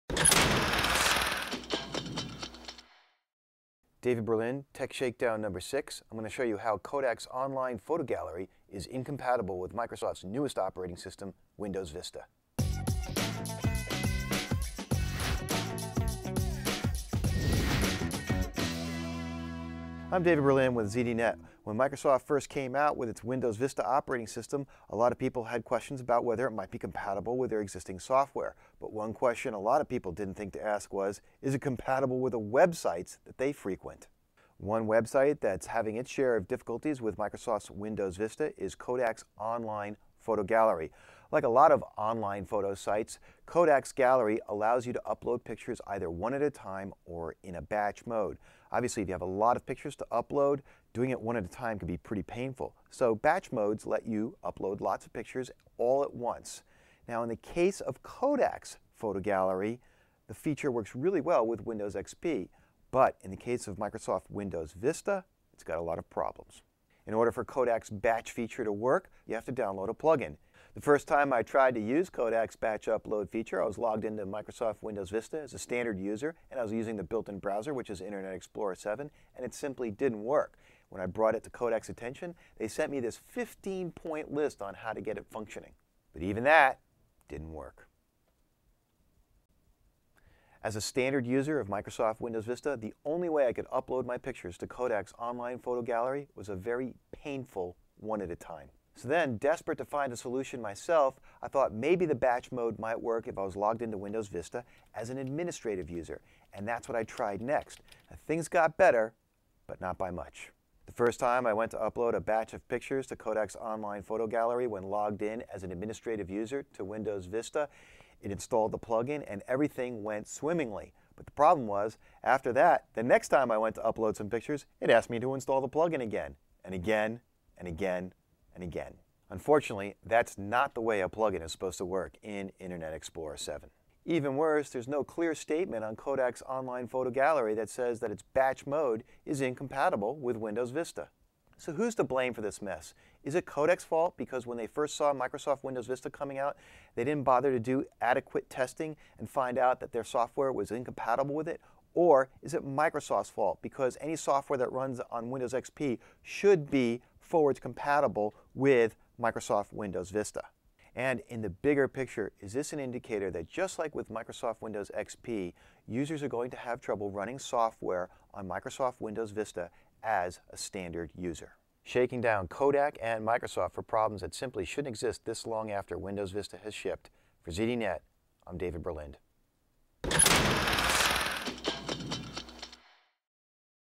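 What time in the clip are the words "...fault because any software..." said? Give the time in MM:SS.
02:33.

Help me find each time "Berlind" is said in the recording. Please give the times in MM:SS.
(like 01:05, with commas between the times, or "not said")
00:04, 00:20, 02:58.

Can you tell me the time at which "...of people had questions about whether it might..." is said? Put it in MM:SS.
00:25.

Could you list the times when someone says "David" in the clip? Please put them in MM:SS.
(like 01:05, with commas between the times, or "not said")
00:04, 00:20, 02:58.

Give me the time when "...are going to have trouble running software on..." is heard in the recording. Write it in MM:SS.
02:46.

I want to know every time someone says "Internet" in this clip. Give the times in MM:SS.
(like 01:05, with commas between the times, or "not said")
01:18, 02:12.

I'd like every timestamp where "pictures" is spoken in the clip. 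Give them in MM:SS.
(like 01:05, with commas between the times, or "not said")
00:45, 00:49, 00:55, 01:34, 01:52, 02:04, 02:41.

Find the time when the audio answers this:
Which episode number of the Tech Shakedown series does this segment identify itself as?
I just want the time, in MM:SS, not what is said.
00:05.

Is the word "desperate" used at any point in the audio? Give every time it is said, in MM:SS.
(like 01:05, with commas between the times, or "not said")
01:39.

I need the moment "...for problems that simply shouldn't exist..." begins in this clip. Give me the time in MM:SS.
02:53.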